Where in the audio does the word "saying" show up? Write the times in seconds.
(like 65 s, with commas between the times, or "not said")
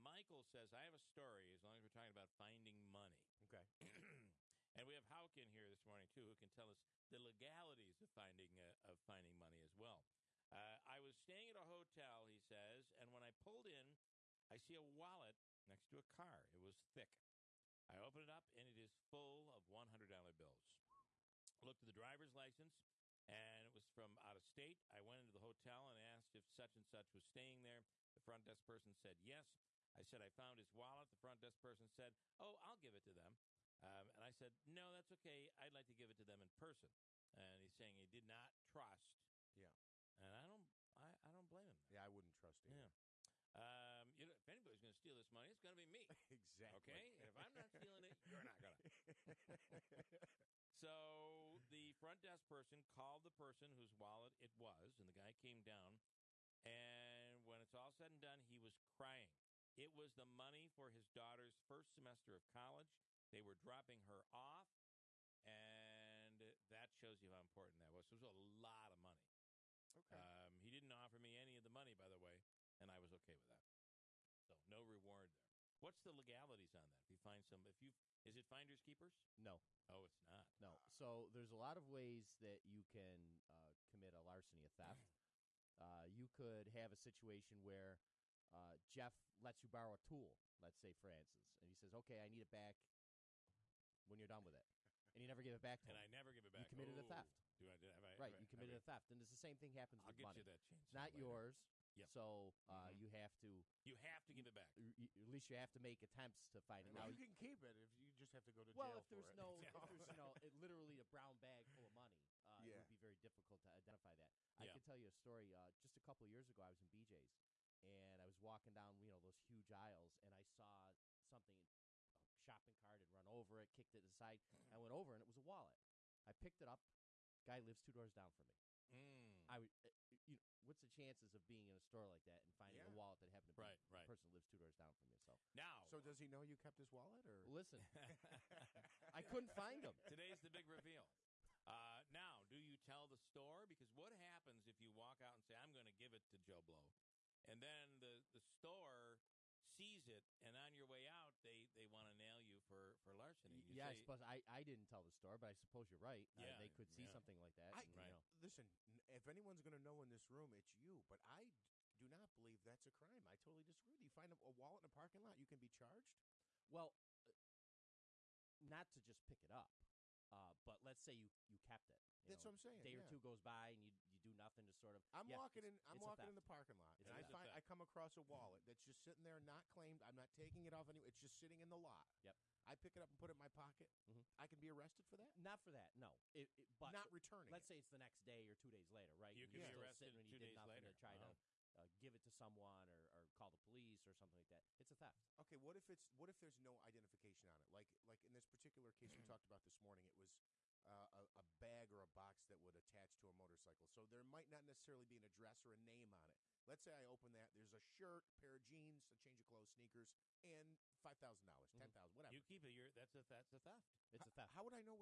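37 s, 172 s.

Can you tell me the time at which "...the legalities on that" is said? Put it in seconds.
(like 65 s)
76 s.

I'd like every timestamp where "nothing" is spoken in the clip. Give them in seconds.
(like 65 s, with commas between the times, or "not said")
174 s, 190 s.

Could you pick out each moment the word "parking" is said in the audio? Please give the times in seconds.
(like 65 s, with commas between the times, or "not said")
164 s, 176 s.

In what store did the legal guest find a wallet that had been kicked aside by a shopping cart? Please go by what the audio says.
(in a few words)
BJ's.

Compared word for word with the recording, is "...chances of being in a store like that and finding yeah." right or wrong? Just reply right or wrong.
right.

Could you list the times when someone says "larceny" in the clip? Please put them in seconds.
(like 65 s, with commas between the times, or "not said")
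84 s, 153 s.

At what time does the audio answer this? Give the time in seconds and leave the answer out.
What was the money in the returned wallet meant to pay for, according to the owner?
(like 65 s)
61 s.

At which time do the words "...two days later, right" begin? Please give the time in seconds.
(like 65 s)
188 s.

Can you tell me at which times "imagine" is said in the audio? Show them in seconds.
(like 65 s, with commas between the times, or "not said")
not said.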